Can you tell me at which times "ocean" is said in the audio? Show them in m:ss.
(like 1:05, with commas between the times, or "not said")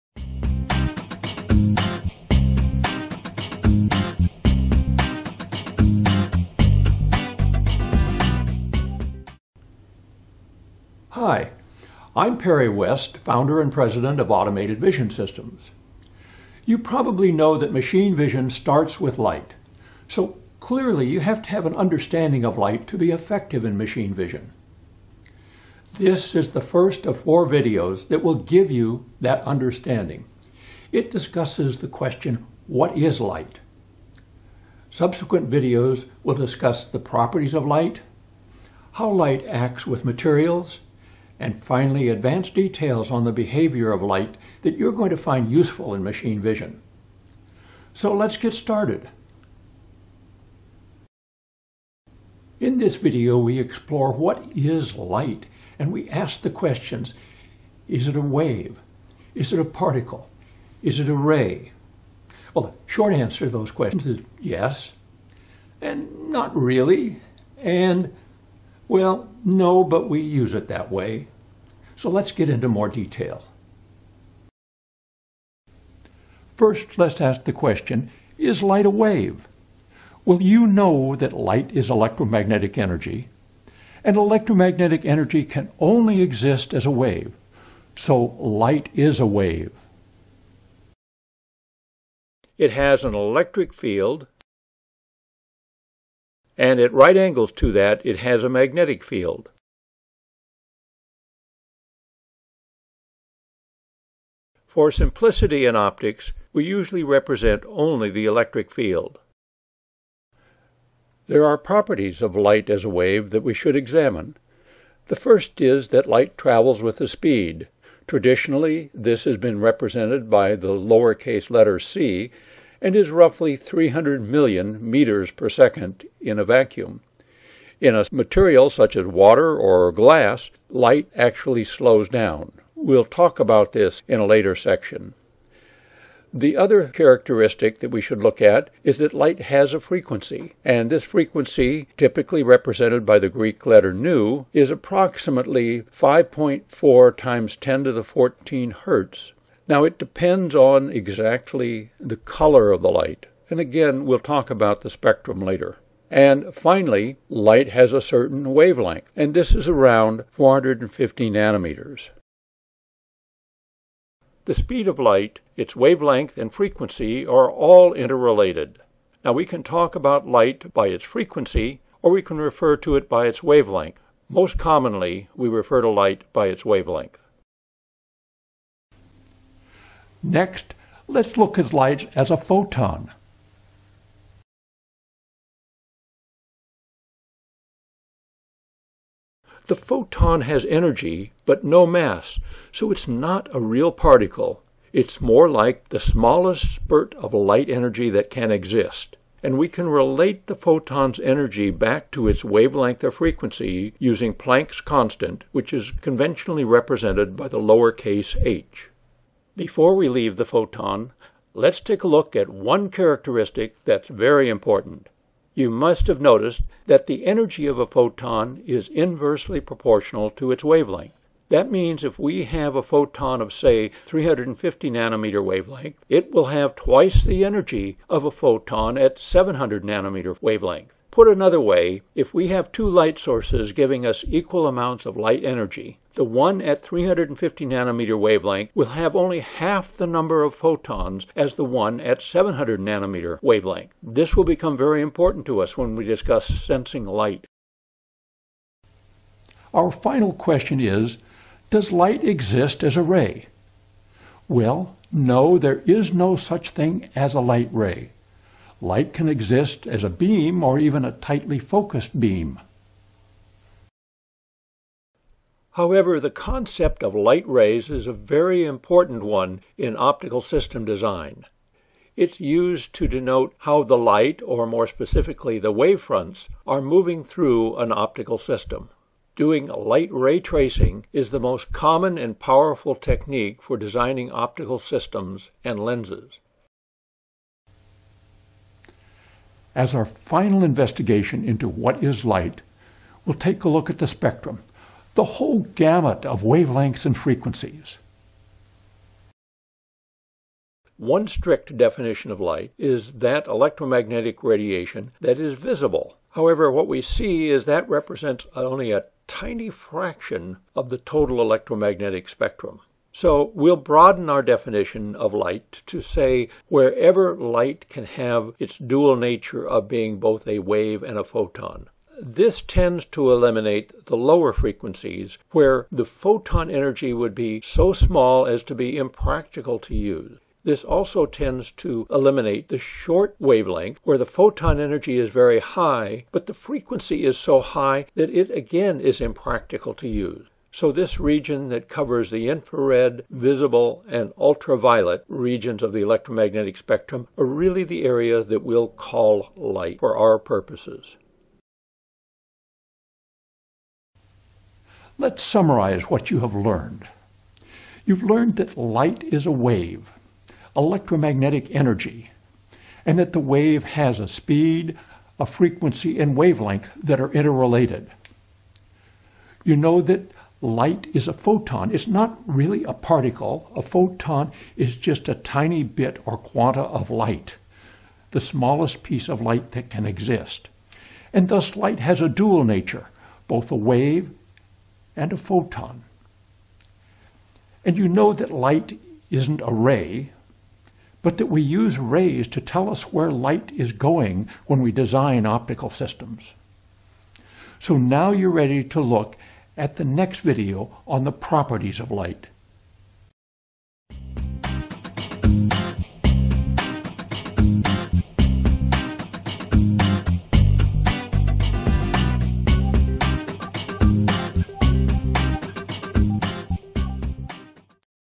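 not said.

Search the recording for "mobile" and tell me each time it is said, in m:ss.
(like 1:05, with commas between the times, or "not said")
not said.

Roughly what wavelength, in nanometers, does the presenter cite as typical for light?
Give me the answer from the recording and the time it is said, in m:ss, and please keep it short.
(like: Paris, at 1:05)
450 nanometers, at 2:40.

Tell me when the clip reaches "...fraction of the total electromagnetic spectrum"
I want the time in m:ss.
5:09.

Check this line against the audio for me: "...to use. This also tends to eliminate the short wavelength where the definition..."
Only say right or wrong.
wrong.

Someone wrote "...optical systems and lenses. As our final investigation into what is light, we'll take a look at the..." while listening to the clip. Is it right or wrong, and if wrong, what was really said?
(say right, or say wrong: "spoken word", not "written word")
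right.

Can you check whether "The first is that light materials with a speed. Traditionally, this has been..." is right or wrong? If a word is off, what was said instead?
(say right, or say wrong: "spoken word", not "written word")
wrong: "travels", not "materials".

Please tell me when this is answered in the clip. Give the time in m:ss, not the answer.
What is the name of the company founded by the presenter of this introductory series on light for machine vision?
0:14.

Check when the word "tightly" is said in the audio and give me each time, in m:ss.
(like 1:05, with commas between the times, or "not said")
4:21.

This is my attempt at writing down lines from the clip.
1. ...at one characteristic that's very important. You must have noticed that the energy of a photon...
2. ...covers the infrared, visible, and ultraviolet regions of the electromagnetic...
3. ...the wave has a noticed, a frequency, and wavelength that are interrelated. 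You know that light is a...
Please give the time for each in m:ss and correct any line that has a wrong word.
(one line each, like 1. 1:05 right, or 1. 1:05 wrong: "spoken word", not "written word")
1. 3:32 right
2. 5:41 right
3. 6:03 wrong: "speed", not "noticed".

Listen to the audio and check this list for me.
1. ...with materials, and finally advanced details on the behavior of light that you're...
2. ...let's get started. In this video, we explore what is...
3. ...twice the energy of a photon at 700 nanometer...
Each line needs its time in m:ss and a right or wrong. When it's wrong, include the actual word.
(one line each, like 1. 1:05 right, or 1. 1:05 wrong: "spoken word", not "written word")
1. 0:39 right
2. 0:48 right
3. 3:46 right.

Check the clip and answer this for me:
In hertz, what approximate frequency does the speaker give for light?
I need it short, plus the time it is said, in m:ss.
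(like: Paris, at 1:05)
5.4 times 10 to the 14 hertz, at 2:25.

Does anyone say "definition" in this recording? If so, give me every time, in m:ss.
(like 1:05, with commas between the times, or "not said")
5:01, 5:14.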